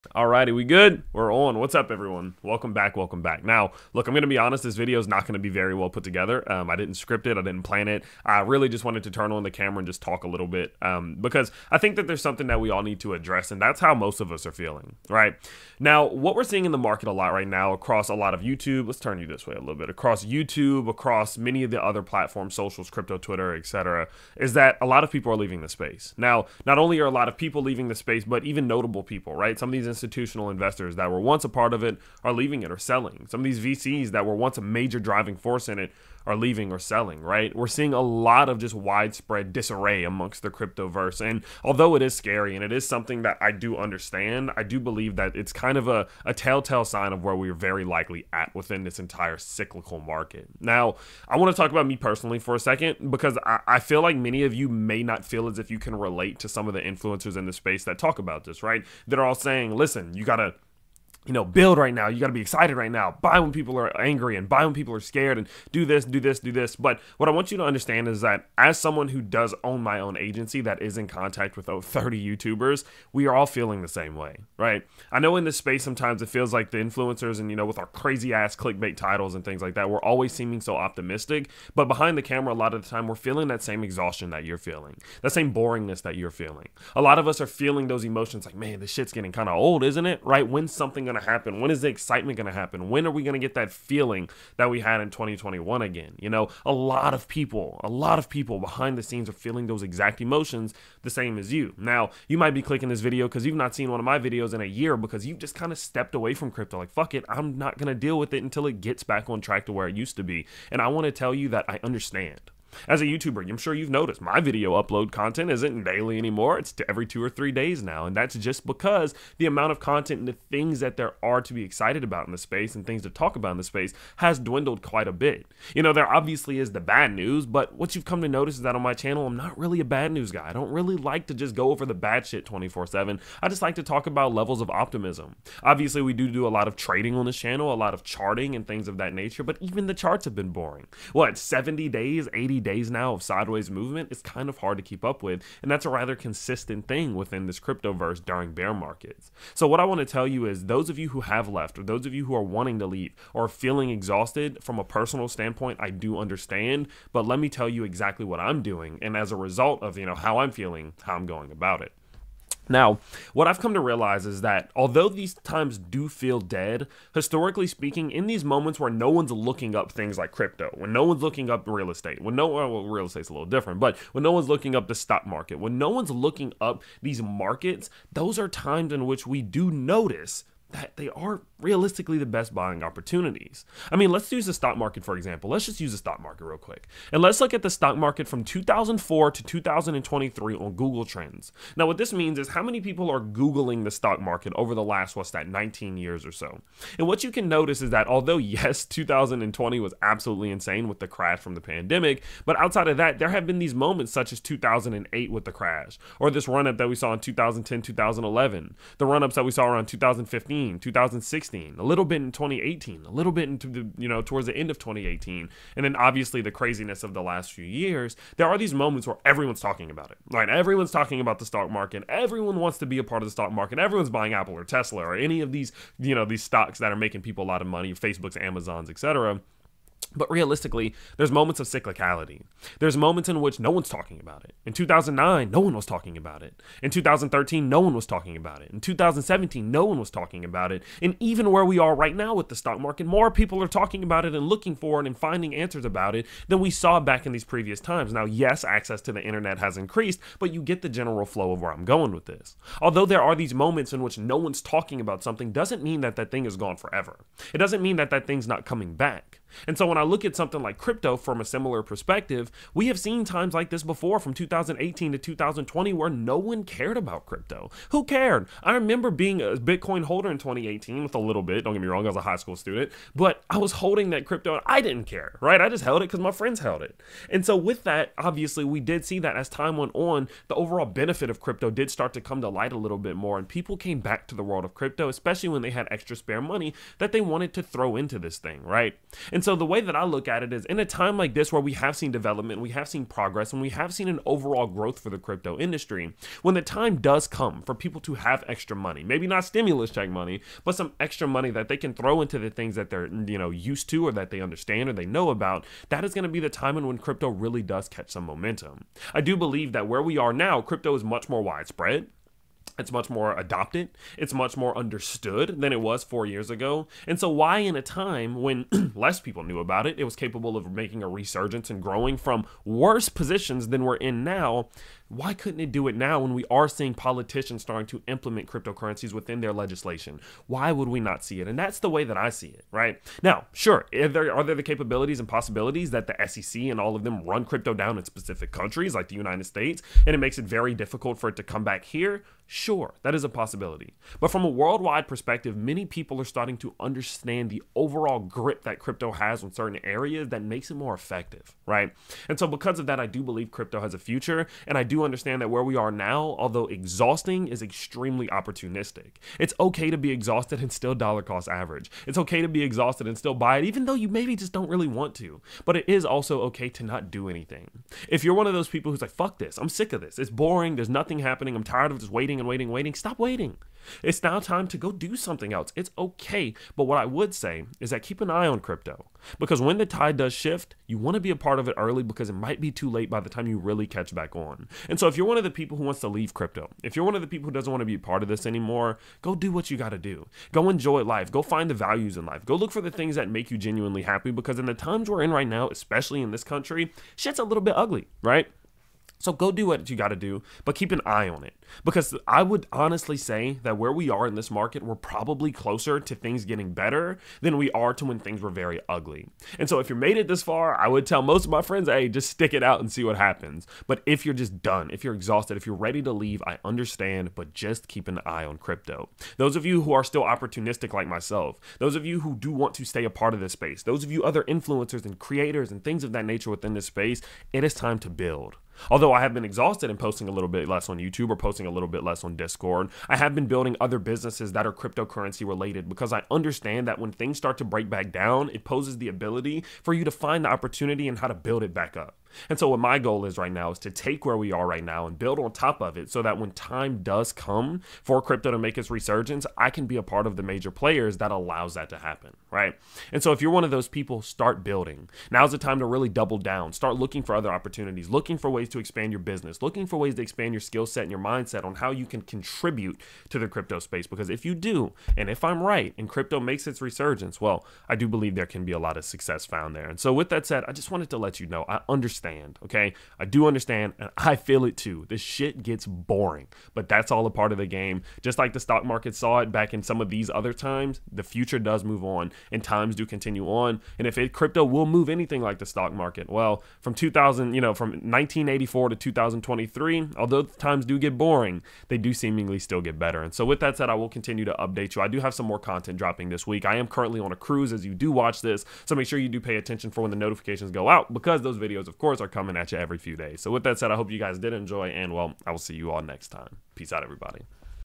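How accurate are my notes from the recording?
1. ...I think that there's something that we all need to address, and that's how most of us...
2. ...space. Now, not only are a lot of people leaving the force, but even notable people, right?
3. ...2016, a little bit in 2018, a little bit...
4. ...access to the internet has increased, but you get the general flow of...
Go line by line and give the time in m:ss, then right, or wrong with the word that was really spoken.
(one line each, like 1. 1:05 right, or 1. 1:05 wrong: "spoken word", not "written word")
1. 0:11 right
2. 0:25 wrong: "space", not "force"
3. 3:30 right
4. 4:08 right.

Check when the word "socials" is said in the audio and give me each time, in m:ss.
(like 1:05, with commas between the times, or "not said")
0:22.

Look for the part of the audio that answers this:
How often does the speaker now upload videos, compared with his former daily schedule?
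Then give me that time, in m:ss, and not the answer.
1:56.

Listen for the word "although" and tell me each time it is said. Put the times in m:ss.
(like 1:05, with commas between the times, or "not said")
0:41, 2:44, 3:18, 4:12, 5:56, 7:08, 8:10.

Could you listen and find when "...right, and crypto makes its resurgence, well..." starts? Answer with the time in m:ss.
7:45.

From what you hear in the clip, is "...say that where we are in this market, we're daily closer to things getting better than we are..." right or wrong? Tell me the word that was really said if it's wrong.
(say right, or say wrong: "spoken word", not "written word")
wrong: "probably", not "daily".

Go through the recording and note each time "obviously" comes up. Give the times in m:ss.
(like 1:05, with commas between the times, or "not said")
2:06, 2:15, 3:35, 4:38.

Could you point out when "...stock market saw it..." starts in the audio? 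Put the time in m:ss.
7:58.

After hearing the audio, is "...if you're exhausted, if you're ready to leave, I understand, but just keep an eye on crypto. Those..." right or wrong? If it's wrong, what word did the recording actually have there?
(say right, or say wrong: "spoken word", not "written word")
right.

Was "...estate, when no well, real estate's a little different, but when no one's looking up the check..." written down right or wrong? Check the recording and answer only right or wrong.
wrong.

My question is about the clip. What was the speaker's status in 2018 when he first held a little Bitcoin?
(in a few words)
High school student.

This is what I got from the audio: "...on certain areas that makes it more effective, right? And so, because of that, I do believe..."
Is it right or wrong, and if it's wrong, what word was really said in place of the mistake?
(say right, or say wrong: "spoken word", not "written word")
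right.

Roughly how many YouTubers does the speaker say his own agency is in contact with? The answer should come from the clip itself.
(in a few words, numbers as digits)
30.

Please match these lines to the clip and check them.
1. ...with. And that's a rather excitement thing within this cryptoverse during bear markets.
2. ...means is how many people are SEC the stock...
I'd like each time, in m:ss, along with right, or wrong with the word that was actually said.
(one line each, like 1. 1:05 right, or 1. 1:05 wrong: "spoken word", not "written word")
1. 2:25 wrong: "consistent", not "excitement"
2. 3:12 wrong: "Googling", not "SEC".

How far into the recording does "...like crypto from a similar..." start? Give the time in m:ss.
4:20.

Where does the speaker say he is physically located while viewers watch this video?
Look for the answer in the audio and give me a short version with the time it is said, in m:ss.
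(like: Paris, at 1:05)
On a cruise, at 8:17.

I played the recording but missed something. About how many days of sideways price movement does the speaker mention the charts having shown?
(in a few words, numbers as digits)
70 to 80 days.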